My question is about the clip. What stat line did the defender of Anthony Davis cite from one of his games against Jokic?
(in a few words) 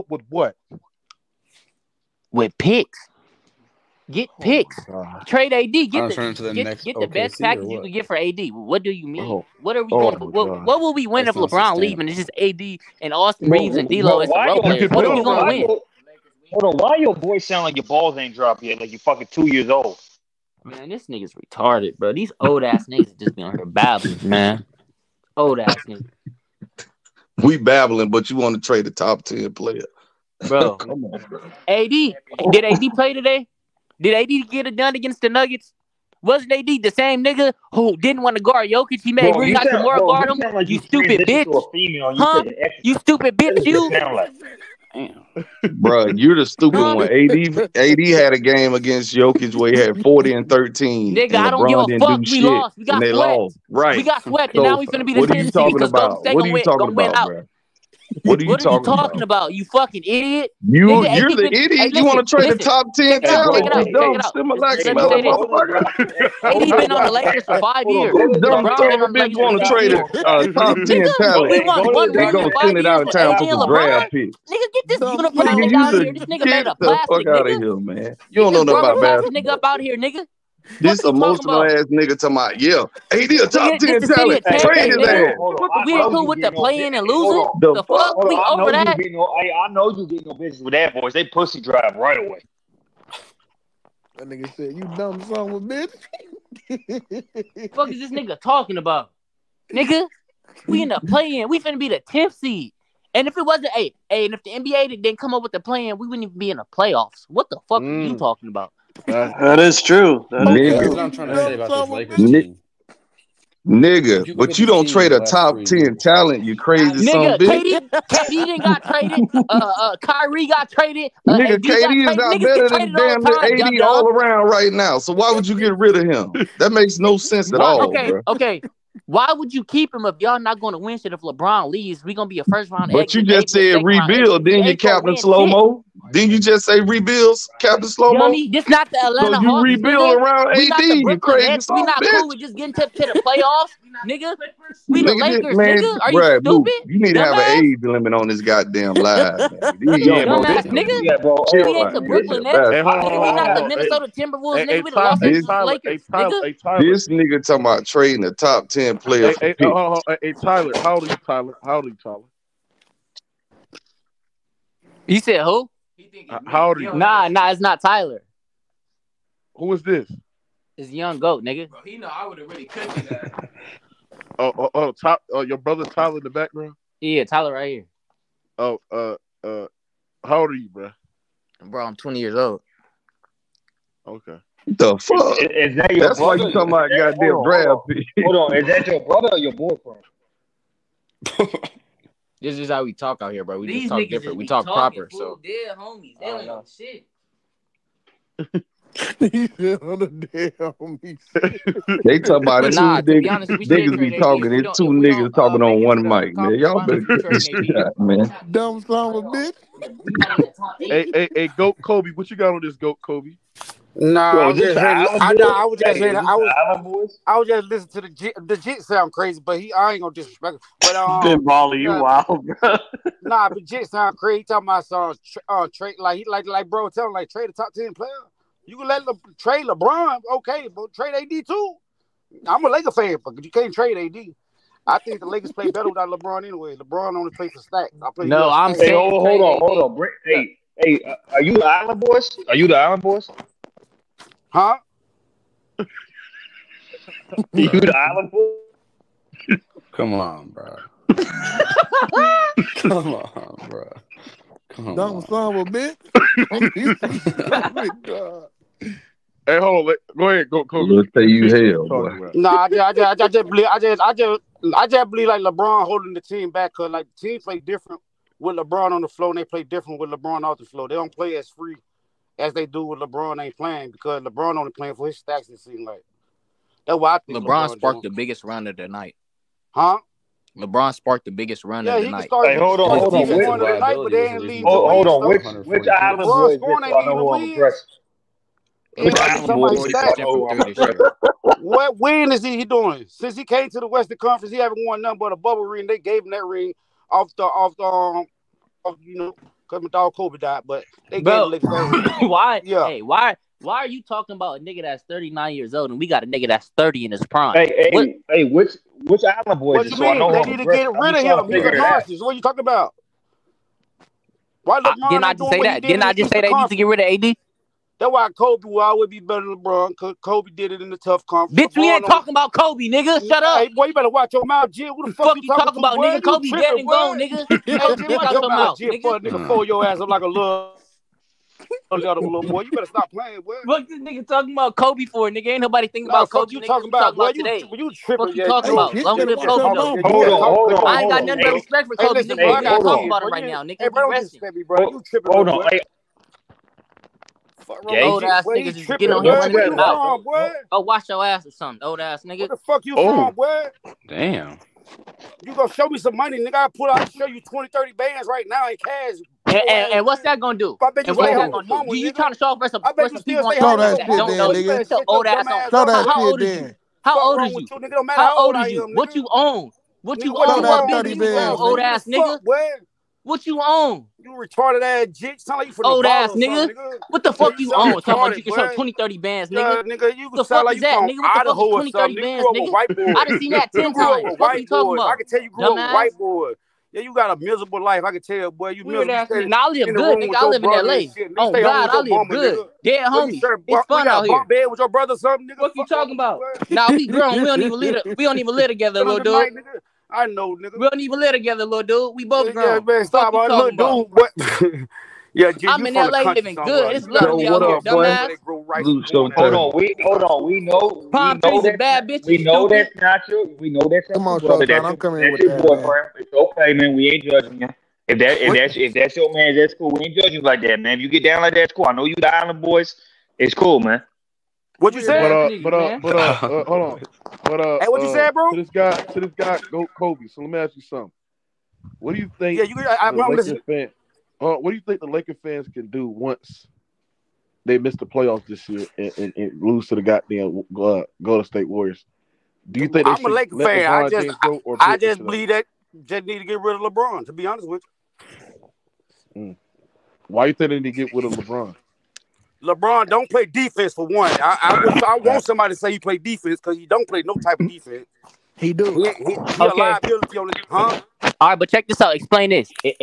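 40 and 13.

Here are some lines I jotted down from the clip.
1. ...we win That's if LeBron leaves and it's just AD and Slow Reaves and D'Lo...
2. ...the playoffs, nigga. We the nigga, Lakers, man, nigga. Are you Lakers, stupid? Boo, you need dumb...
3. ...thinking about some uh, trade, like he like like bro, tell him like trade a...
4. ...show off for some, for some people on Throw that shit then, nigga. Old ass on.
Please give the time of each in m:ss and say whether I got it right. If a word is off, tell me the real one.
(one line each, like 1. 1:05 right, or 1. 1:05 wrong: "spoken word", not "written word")
1. 0:10 wrong: "Austin", not "Slow"
2. 2:22 wrong: "Brad", not "Lakers"
3. 3:44 wrong: "talking", not "thinking"
4. 6:02 right.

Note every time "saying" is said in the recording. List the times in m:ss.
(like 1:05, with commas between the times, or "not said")
3:35, 3:58.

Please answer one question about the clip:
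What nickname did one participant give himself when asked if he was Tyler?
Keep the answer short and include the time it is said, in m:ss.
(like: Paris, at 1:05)
Young Goat, at 2:50.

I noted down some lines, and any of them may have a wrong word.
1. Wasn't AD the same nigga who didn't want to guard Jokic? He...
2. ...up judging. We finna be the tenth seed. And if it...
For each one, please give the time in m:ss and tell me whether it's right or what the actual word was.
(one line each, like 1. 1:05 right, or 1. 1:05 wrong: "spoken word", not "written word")
1. 0:36 right
2. 1:40 wrong: "playing", not "judging".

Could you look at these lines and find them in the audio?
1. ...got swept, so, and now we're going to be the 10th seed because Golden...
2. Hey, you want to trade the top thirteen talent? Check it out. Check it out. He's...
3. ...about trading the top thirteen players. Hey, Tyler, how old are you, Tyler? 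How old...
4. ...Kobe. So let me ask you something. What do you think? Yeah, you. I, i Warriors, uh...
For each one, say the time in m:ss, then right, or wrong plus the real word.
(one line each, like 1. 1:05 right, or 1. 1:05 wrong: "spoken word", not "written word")
1. 0:54 right
2. 1:01 wrong: "ten", not "thirteen"
3. 2:37 wrong: "ten", not "thirteen"
4. 7:09 wrong: "Fan", not "Warriors".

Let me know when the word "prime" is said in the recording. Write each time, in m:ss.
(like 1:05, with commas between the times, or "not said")
5:07.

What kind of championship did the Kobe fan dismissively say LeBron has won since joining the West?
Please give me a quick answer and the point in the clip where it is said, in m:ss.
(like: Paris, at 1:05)
bubble ring, at 4:55.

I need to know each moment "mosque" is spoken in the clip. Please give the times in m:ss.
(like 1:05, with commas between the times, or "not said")
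not said.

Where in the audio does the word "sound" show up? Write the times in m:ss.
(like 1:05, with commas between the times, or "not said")
0:17, 3:38, 3:43, 6:15.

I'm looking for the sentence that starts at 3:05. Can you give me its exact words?
Is, is that your That's brother?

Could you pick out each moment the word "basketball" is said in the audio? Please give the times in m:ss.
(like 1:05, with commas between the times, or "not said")
1:19.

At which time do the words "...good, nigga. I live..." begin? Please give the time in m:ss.
6:29.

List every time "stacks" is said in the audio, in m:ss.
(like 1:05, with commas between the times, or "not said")
3:57, 4:35.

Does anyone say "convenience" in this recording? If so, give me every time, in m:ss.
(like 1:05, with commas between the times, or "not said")
not said.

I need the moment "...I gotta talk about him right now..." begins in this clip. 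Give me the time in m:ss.
5:42.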